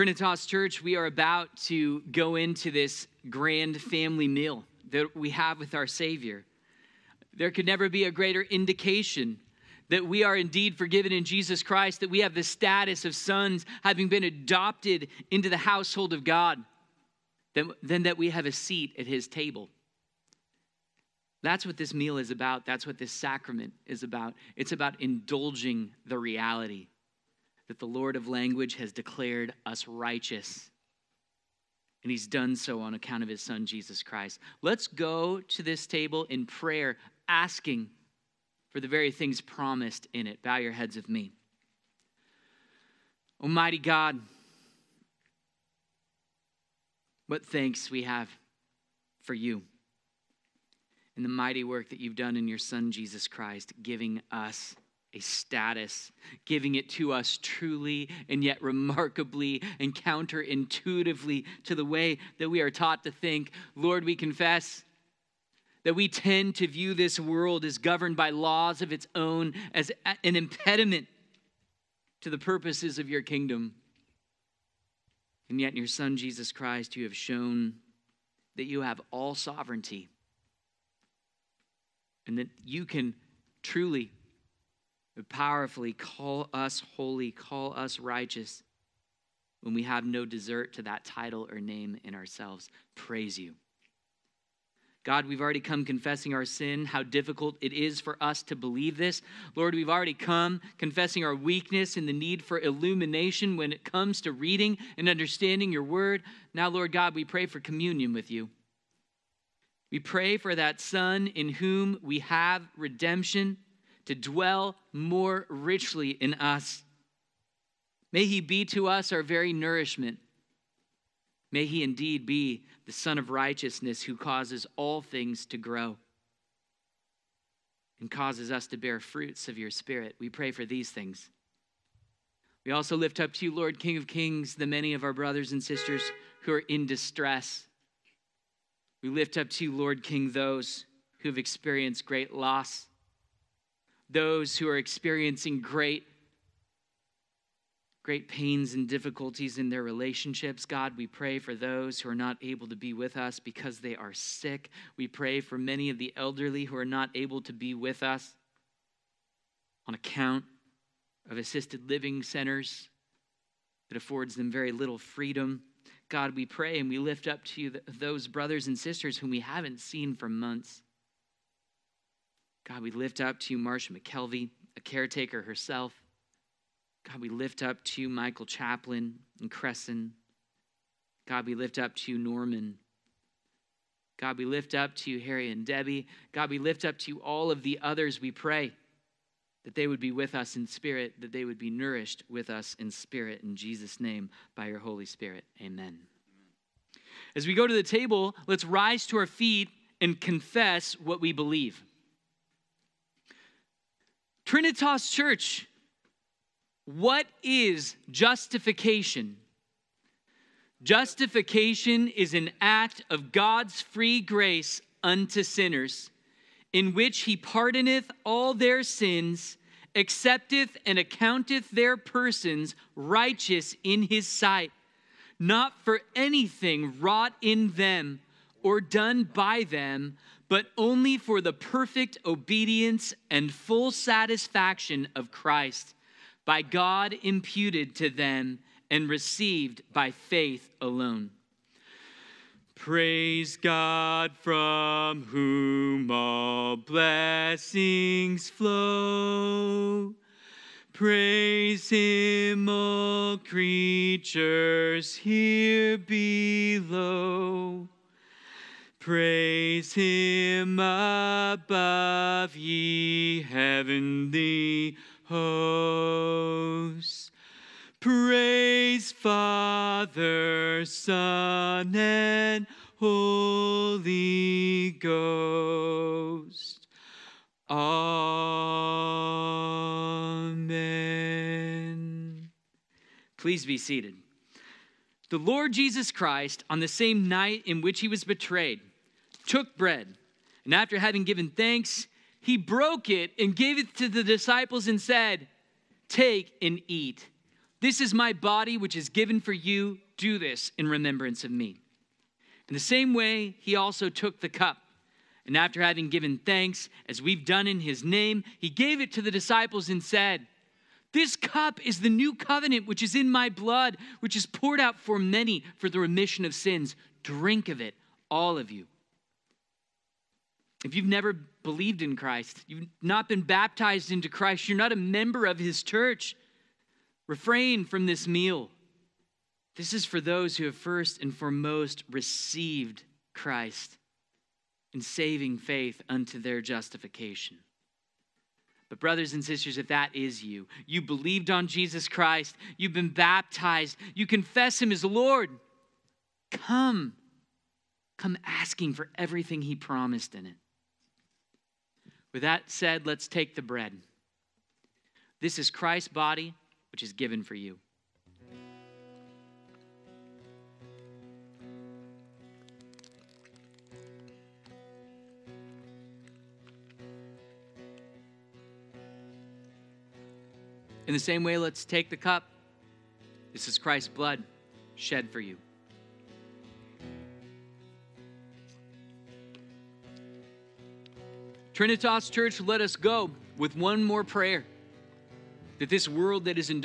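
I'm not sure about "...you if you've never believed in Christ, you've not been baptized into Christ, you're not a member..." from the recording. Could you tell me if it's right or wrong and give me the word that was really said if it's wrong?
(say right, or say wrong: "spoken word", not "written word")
right.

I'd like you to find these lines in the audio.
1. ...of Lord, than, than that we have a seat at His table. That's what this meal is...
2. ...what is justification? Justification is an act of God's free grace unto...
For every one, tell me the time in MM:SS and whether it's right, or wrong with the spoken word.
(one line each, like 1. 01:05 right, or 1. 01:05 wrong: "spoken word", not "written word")
1. 00:16 wrong: "God", not "Lord"
2. 03:26 right.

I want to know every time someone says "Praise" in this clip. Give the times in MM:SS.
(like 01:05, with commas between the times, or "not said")
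01:32, 04:02, 04:10, 04:19, 04:28.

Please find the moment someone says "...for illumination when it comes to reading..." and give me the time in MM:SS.
01:42.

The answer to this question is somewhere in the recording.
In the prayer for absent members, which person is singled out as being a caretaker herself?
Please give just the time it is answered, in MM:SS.
02:53.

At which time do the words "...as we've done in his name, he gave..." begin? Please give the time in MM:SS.
05:07.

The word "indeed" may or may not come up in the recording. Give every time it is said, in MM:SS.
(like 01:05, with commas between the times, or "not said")
00:10, 02:01.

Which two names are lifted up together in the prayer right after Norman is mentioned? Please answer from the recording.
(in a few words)
Harry and Debbie.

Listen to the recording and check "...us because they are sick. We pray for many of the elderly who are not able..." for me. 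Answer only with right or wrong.
right.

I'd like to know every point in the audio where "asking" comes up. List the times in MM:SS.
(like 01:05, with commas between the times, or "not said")
00:37, 05:48.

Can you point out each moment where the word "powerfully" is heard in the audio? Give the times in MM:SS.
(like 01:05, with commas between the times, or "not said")
01:25.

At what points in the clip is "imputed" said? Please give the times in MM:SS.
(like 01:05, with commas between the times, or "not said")
03:57.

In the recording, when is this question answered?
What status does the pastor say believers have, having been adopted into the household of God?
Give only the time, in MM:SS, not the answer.
00:12.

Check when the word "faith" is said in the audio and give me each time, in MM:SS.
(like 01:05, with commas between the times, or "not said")
04:00, 05:35.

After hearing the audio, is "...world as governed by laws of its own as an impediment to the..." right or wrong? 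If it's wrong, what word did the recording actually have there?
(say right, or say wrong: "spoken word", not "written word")
right.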